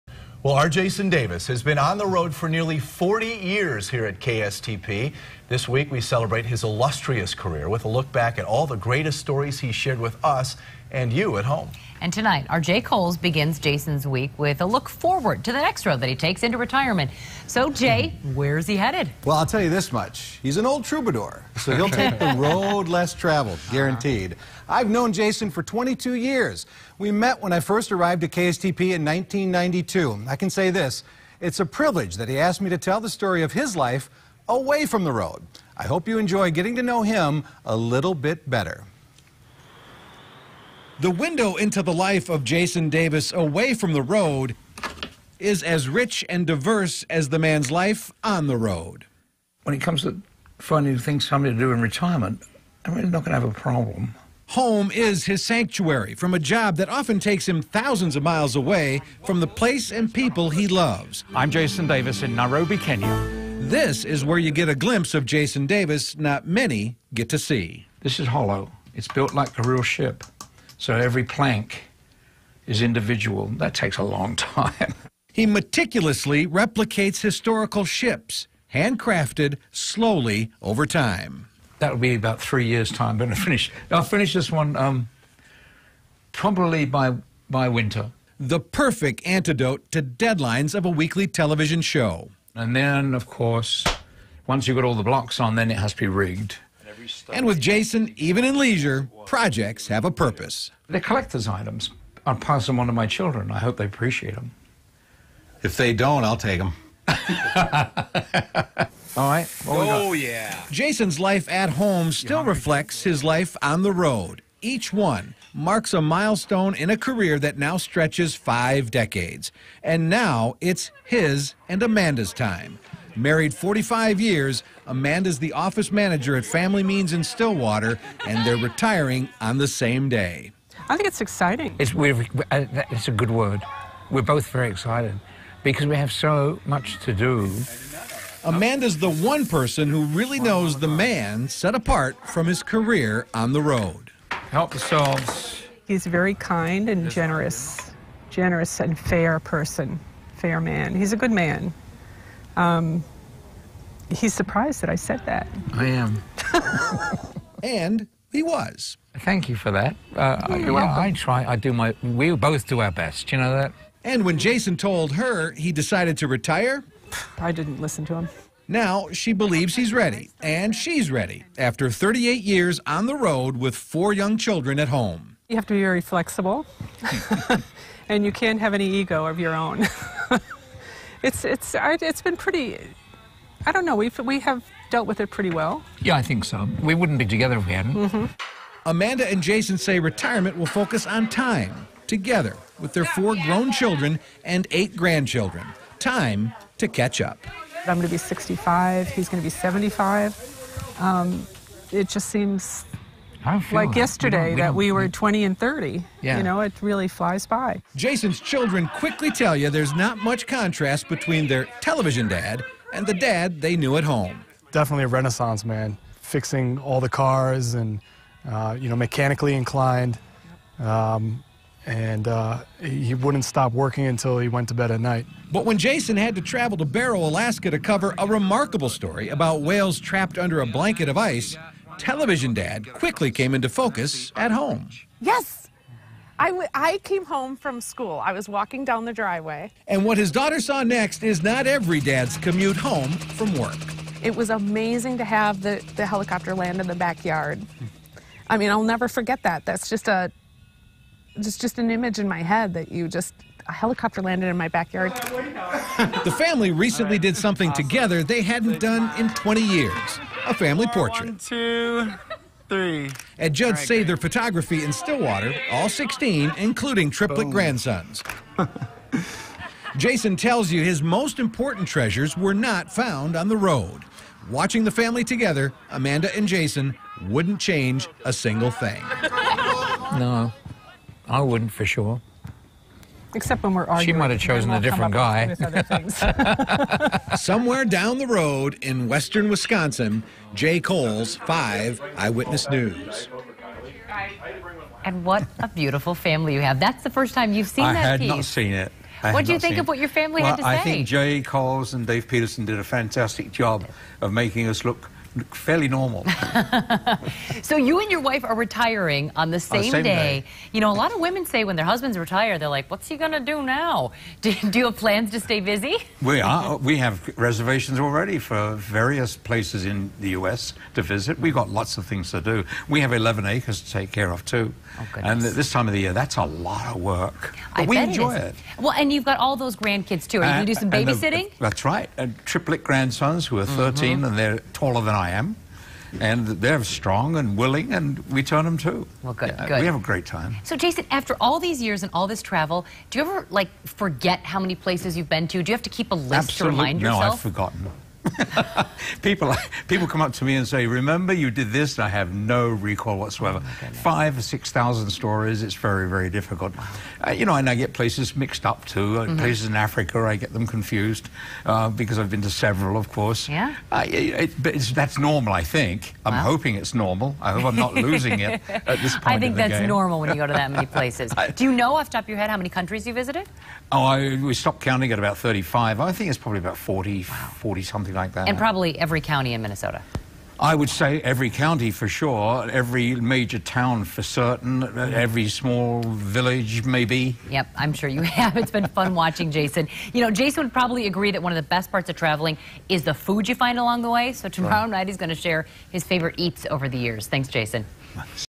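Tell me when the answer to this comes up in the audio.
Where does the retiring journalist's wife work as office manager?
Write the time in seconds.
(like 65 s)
126 s.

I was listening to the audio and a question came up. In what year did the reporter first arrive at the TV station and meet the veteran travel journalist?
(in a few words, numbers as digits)
1992.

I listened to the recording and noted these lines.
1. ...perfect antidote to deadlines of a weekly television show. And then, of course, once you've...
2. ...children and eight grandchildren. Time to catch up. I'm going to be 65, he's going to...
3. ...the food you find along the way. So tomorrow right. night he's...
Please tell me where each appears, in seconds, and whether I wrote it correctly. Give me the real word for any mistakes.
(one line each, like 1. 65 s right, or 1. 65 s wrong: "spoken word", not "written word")
1. 88 s right
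2. 193 s right
3. 393 s right.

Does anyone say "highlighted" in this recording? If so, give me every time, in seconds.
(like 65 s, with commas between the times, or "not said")
not said.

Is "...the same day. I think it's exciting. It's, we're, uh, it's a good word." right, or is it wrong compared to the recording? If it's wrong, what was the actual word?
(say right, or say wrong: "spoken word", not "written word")
right.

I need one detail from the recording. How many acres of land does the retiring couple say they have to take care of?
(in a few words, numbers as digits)
11.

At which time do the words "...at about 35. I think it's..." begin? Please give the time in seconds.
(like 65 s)
375 s.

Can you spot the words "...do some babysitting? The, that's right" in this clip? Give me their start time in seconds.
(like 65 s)
330 s.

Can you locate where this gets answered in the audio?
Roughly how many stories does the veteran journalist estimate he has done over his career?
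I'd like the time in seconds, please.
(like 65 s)
353 s.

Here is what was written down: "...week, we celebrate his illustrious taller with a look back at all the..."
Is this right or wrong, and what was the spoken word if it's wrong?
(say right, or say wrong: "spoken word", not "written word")
wrong: "career", not "taller".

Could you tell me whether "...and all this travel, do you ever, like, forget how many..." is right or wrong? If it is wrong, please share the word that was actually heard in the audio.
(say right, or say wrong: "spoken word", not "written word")
right.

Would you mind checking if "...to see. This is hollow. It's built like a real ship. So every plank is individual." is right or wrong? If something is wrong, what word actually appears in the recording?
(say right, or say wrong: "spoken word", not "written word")
right.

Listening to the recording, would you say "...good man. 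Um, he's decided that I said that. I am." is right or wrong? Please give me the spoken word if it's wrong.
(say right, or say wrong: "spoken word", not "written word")
wrong: "surprised", not "decided".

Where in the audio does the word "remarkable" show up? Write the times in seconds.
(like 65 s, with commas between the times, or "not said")
228 s.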